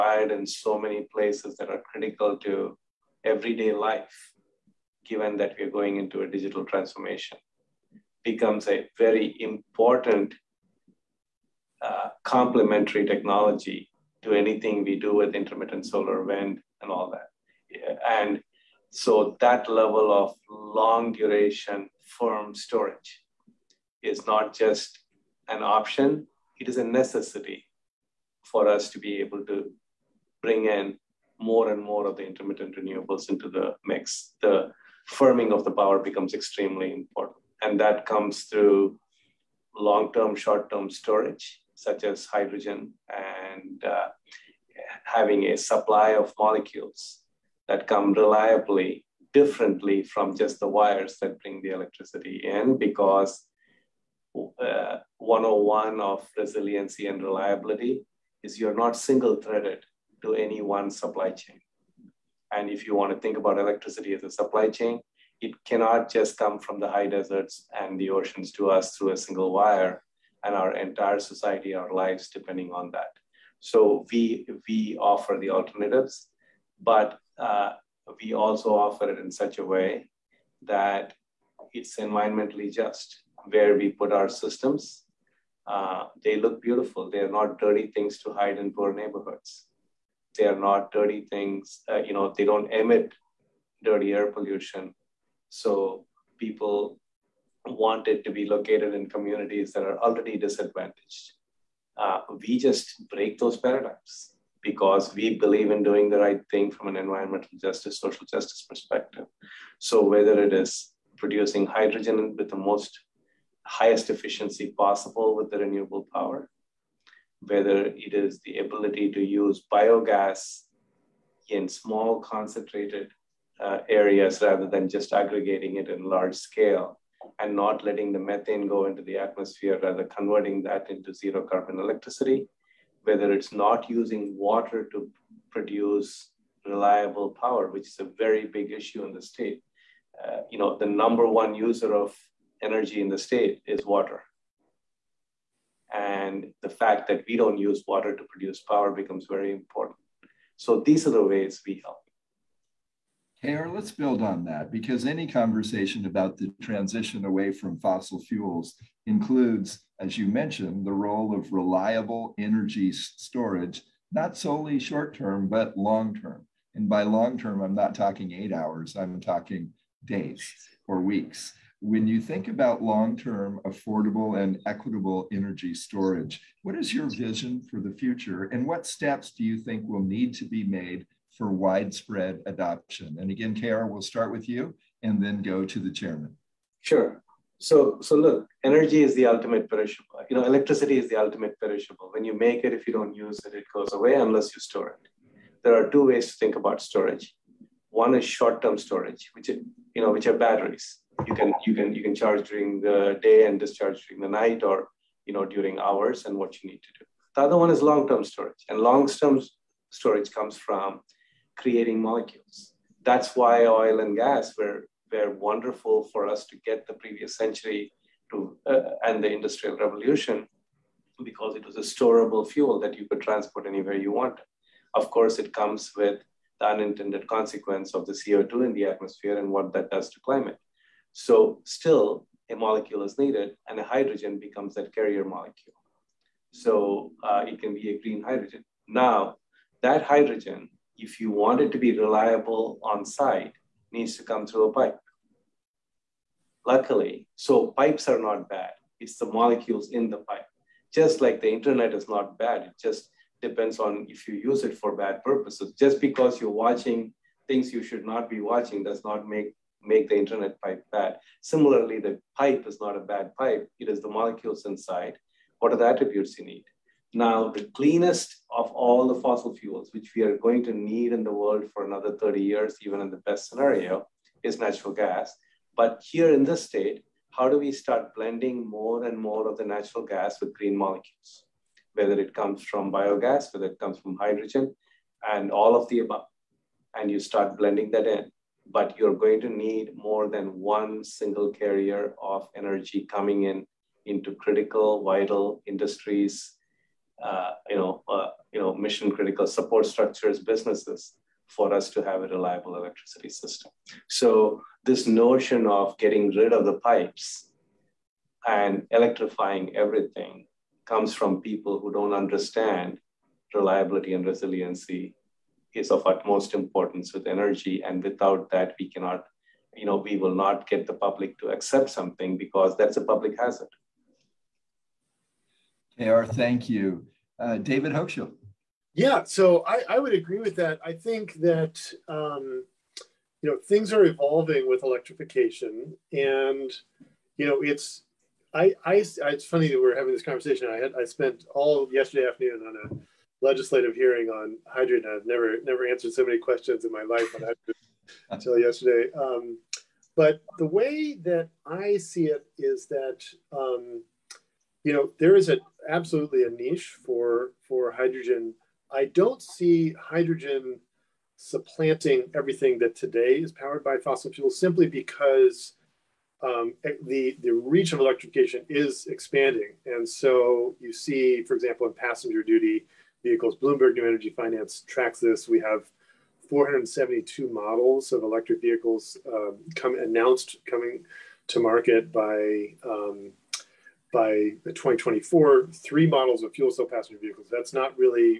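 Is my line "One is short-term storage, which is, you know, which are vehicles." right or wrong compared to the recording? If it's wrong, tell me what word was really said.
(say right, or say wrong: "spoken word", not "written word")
wrong: "batteries", not "vehicles".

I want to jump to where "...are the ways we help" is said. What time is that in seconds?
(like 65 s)
151 s.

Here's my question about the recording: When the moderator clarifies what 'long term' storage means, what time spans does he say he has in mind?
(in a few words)
Days or weeks.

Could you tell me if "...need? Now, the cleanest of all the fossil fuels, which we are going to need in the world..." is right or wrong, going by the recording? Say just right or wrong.
right.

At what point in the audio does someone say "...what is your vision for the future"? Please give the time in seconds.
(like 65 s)
176 s.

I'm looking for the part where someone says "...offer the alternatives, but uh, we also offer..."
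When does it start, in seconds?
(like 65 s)
74 s.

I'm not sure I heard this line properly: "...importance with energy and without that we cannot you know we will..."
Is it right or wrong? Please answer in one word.
right.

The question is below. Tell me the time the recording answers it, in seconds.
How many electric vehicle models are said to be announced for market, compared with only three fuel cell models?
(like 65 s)
376 s.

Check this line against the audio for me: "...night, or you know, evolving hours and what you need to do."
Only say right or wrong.
wrong.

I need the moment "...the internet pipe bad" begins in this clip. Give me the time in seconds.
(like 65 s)
260 s.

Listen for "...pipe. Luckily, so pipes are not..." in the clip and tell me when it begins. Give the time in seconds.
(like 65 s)
244 s.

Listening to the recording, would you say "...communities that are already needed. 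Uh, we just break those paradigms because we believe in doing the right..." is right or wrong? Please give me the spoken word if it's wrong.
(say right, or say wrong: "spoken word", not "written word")
wrong: "disadvantaged", not "needed".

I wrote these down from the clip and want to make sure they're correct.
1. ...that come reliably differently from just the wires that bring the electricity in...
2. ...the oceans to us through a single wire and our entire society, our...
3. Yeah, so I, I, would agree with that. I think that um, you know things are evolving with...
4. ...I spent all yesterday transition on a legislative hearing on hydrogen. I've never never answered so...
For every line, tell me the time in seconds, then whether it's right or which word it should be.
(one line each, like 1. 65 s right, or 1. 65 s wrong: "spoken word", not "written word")
1. 47 s right
2. 67 s right
3. 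328 s right
4. 340 s wrong: "afternoon", not "transition".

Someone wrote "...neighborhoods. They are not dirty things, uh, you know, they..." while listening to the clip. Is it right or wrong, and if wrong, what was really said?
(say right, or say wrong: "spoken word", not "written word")
right.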